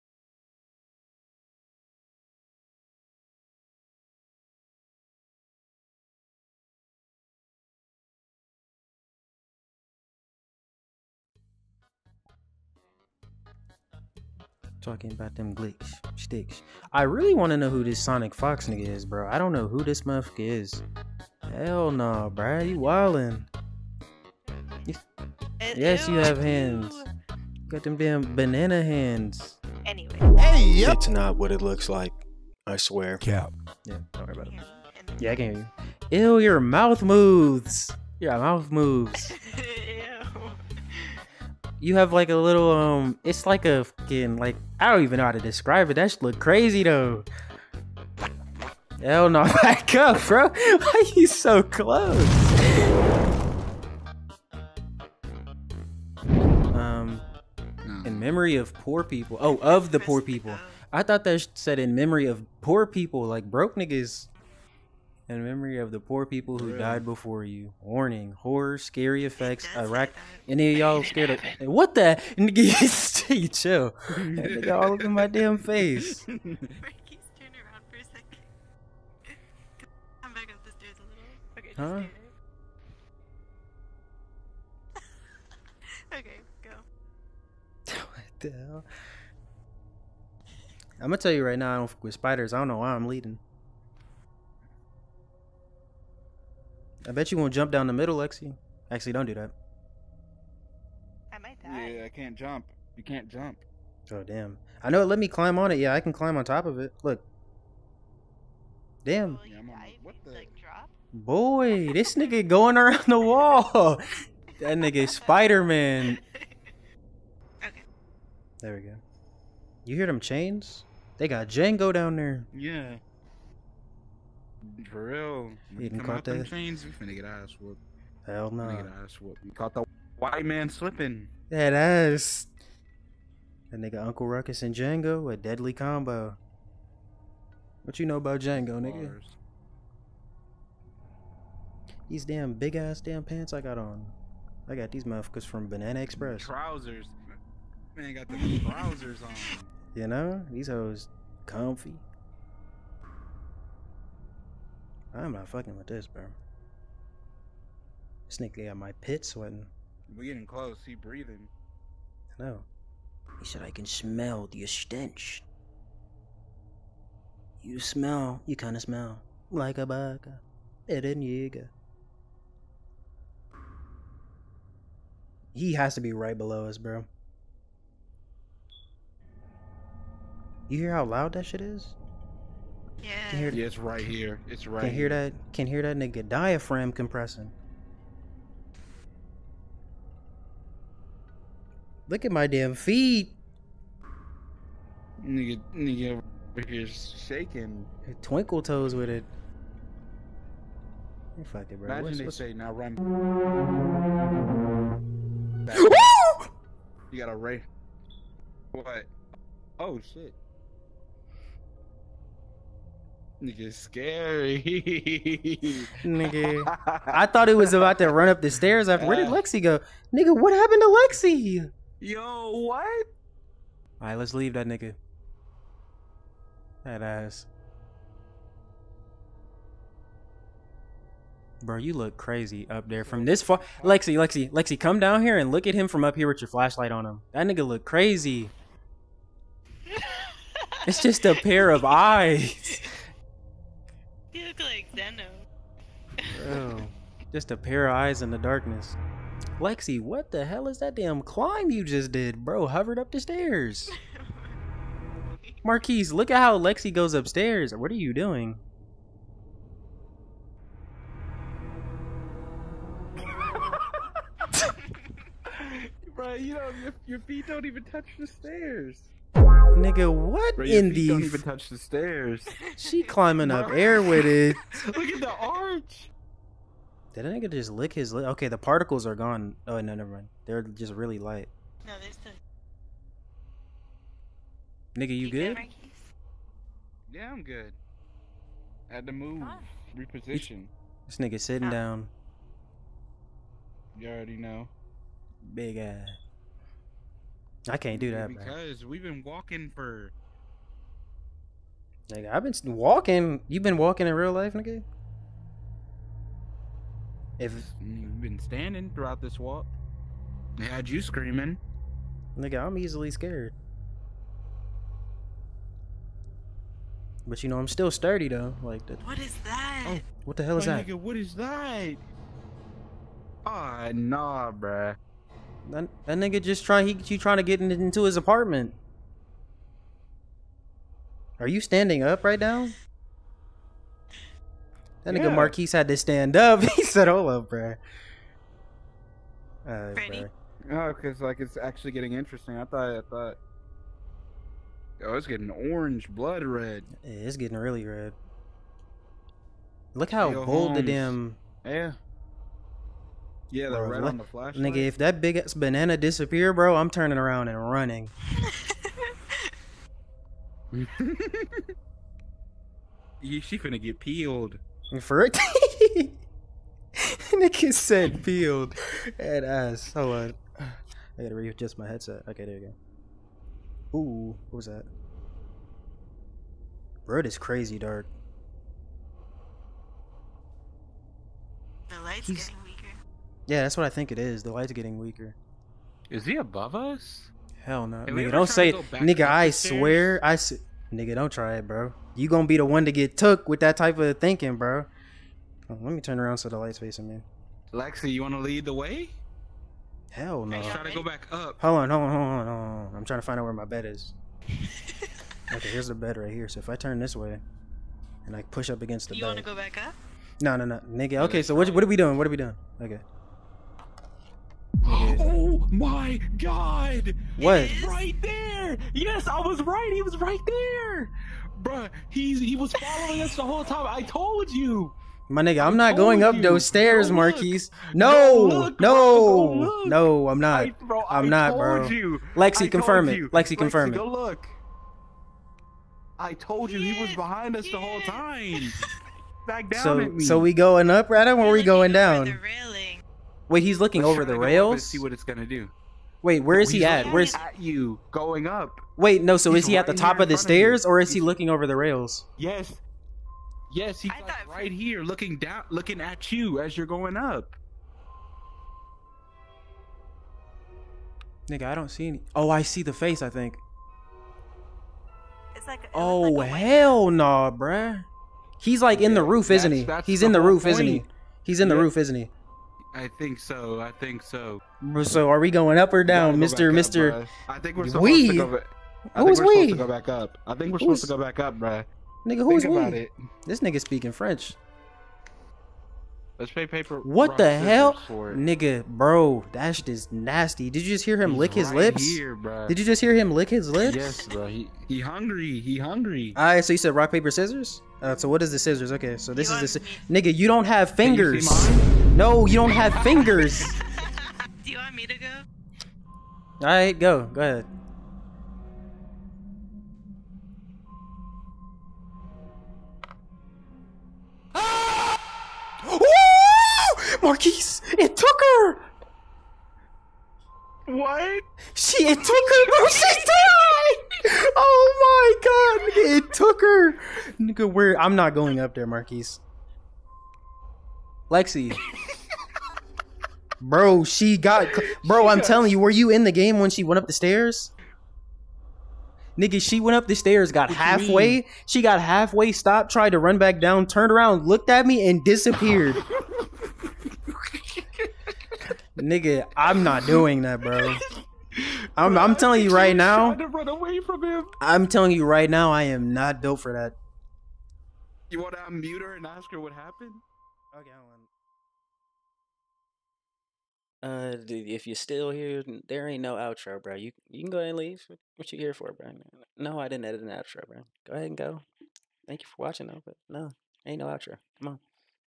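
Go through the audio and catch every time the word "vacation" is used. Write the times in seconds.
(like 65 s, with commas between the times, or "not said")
not said.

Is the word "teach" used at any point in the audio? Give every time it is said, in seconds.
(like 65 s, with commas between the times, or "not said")
not said.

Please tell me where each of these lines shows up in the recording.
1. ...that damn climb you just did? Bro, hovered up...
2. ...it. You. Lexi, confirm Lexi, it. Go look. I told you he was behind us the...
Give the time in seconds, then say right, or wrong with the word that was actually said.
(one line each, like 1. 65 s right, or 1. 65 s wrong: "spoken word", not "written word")
1. 250 s right
2. 433 s right.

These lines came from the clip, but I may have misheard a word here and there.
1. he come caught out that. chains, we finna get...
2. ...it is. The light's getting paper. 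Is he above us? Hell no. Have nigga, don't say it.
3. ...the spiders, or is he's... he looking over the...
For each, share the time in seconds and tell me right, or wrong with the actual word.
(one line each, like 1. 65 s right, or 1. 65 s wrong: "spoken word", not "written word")
1. 125 s right
2. 384 s wrong: "weaker", not "paper"
3. 450 s wrong: "stairs", not "spiders".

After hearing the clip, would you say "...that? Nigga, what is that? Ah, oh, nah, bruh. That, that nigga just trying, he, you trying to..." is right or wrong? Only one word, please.
right.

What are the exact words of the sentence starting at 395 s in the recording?
Oh, let me turn around so the light's facing me.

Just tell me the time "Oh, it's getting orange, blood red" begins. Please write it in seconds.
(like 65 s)
345 s.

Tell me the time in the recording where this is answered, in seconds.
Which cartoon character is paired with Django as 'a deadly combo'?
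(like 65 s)
134 s.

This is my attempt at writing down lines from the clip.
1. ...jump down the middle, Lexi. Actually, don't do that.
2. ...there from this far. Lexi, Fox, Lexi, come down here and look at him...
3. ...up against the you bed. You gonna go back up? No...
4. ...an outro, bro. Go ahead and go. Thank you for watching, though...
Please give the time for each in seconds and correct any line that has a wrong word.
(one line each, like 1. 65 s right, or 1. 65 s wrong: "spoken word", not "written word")
1. 97 s right
2. 232 s wrong: "Lexi", not "Fox"
3. 408 s wrong: "wanna", not "gonna"
4. 570 s right.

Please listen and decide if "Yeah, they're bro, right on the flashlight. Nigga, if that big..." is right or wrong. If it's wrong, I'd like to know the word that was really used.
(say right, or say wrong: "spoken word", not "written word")
right.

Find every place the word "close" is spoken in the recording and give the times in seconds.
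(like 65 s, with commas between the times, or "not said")
51 s, 160 s.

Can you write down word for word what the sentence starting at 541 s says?
She got halfway, stopped, tried to run back down, turned around, looked at me, and disappeared.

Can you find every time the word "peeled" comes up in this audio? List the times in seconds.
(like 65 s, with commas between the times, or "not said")
363 s, 368 s.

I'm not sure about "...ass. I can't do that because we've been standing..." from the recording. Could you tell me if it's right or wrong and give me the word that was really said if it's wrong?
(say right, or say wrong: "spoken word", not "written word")
wrong: "walking", not "standing".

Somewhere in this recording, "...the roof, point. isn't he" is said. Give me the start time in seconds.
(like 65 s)
470 s.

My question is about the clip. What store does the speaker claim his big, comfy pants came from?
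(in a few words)
Banana Express.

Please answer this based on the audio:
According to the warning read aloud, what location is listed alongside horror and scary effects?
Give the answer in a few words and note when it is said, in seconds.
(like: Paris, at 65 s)
Iraq, at 69 s.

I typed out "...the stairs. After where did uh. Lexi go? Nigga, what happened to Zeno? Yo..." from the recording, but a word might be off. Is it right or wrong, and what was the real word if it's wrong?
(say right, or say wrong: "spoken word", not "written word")
wrong: "Lexi", not "Zeno".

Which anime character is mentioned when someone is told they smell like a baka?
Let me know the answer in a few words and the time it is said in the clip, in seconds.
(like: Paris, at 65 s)
Eren Yeager, at 170 s.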